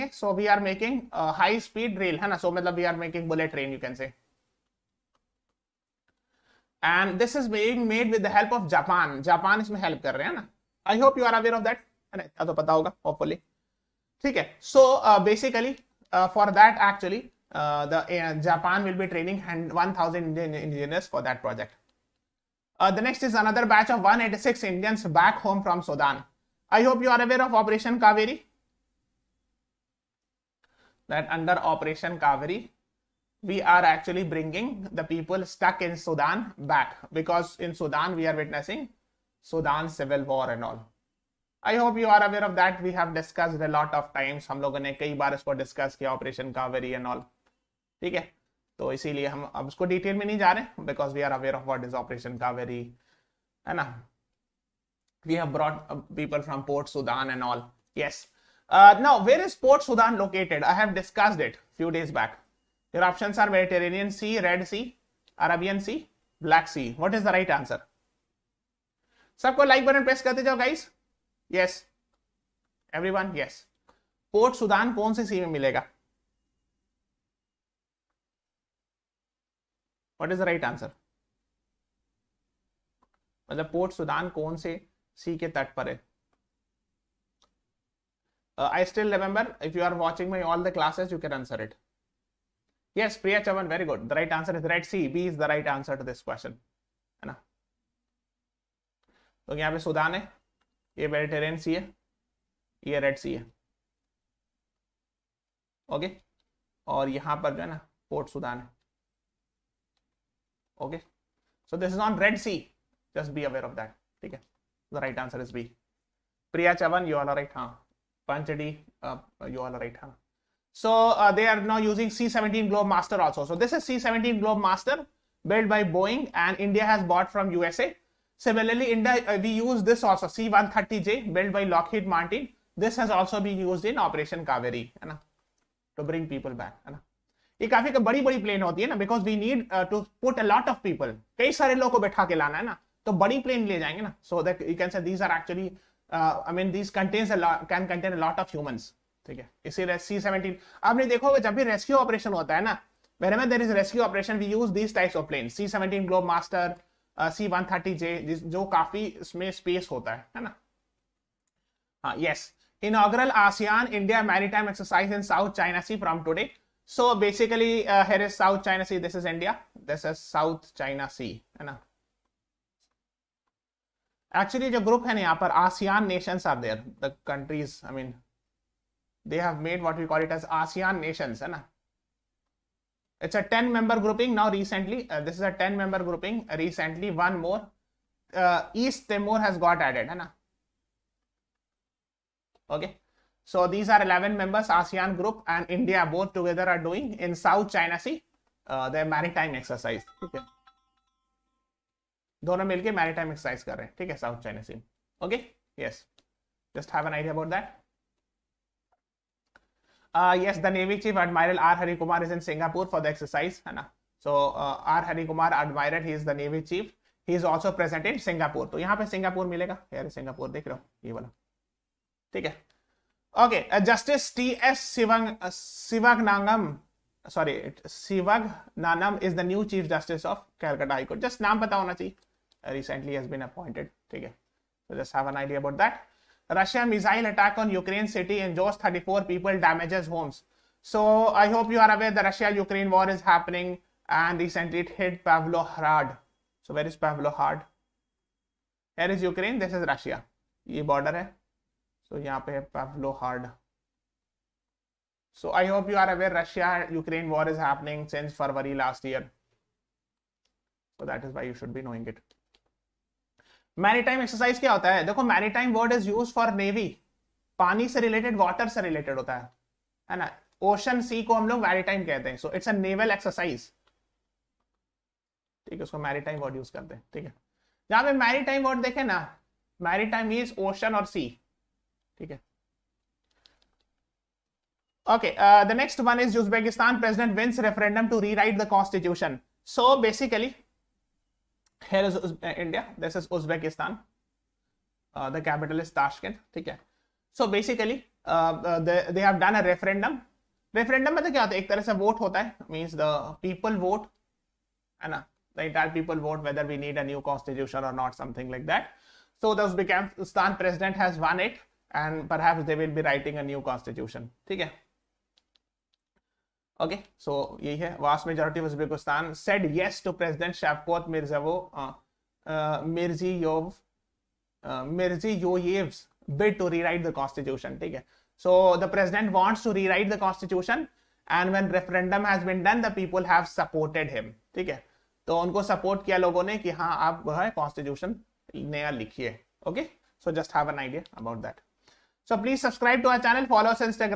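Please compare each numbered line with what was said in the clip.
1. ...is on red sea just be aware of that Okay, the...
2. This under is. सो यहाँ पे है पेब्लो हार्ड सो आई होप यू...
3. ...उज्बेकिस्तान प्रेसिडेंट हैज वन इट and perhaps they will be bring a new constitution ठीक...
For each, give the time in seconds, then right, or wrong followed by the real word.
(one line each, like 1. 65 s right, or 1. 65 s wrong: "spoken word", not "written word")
1. 111 s right
2. 250 s wrong: "border", not "under"
3. 309 s wrong: "writing", not "bring".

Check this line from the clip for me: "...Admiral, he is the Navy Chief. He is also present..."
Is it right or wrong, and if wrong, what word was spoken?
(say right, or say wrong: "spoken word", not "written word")
right.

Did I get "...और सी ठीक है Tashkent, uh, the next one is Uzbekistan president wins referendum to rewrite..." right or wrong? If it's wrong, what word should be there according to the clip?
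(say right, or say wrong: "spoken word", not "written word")
wrong: "Okay", not "Tashkent".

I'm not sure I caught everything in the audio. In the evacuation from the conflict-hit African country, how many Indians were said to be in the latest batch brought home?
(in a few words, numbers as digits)
186.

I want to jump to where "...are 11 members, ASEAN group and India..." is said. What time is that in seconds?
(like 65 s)
193 s.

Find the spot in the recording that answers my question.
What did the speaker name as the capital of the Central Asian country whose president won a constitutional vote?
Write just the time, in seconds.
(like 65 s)
295 s.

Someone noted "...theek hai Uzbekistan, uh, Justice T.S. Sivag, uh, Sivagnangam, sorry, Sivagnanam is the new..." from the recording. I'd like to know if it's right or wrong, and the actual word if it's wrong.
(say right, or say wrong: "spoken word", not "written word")
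wrong: "Okay", not "Uzbekistan".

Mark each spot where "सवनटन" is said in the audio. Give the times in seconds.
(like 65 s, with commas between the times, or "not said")
150 s, 155 s.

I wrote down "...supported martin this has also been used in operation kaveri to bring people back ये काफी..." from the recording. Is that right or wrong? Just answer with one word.
wrong.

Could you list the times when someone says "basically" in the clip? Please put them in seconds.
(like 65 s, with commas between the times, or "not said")
167 s, 290 s, 297 s.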